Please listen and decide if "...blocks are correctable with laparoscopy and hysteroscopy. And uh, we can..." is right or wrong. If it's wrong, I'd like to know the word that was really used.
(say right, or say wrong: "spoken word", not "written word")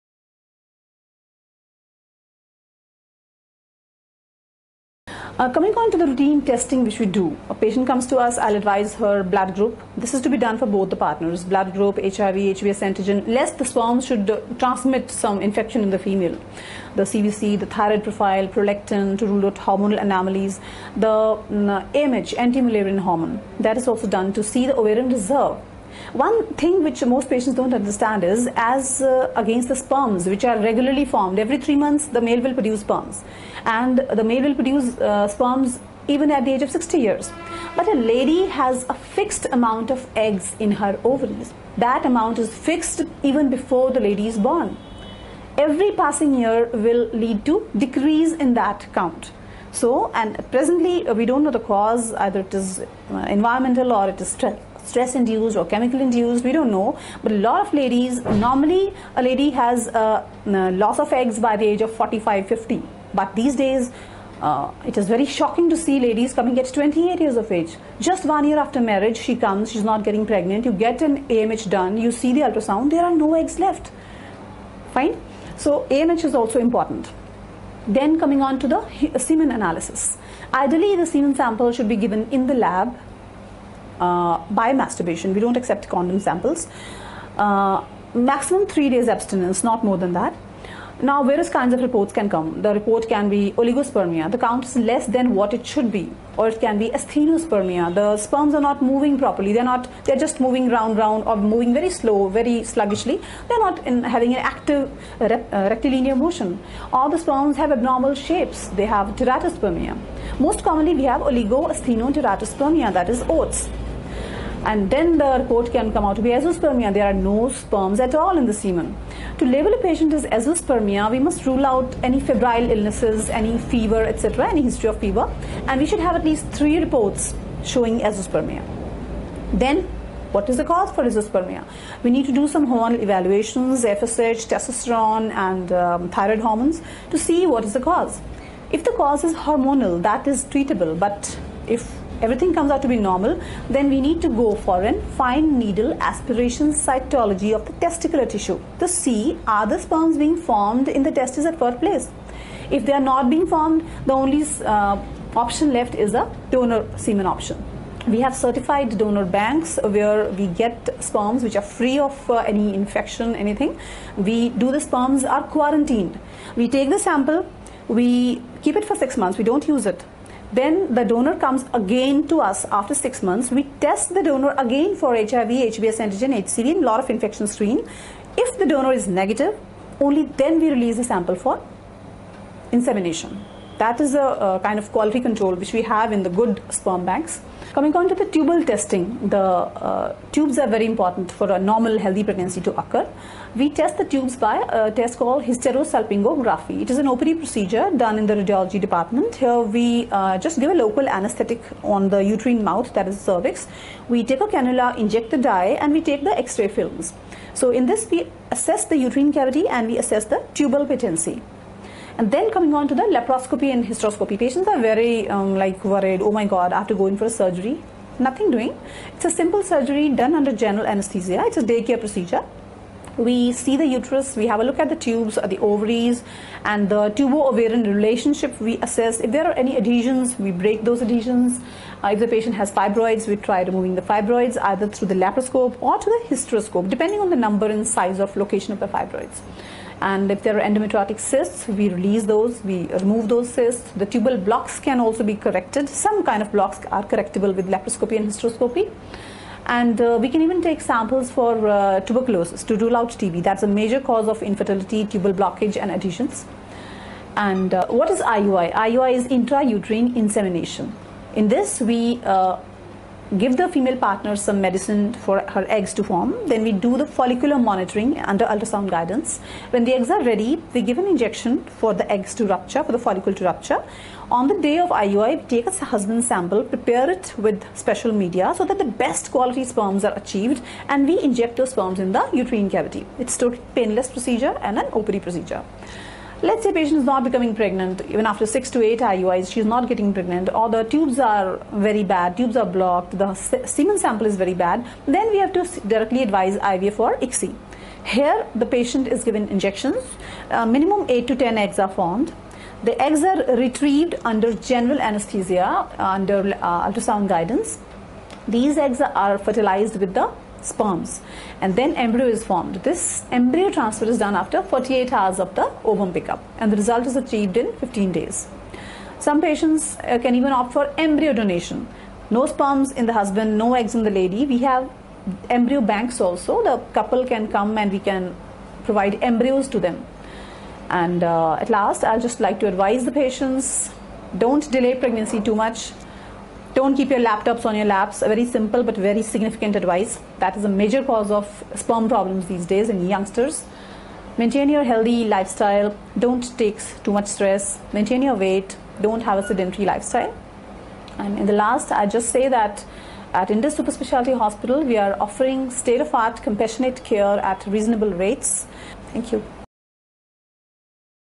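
right.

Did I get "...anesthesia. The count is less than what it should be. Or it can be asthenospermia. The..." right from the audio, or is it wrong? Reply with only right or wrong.
wrong.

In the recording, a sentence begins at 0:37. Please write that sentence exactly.
But a lady has a fixed amount of eggs in her ovaries.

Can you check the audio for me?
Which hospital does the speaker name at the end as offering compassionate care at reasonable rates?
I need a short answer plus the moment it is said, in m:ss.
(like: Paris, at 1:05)
Indus Super Specialty Hospital, at 5:53.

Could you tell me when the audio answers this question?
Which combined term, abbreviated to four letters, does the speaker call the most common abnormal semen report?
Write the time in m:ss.
1:51.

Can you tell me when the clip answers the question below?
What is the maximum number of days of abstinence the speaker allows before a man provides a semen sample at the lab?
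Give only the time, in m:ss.
1:28.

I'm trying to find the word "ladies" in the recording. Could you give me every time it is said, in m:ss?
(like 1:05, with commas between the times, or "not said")
0:57, 1:06.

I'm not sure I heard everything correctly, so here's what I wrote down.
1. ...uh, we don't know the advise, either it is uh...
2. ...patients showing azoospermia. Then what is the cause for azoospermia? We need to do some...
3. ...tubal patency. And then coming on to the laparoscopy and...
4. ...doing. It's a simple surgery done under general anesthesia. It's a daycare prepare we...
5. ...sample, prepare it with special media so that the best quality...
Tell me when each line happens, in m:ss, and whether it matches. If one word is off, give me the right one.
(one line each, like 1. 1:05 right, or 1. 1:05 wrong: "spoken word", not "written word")
1. 0:51 wrong: "cause", not "advise"
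2. 2:06 wrong: "reports", not "patients"
3. 3:30 right
4. 3:38 wrong: "procedure", not "prepare"
5. 4:36 right.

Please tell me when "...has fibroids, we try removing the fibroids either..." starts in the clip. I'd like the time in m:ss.
3:52.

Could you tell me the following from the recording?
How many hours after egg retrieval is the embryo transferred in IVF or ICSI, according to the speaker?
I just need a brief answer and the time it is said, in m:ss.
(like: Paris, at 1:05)
48 hours, at 5:14.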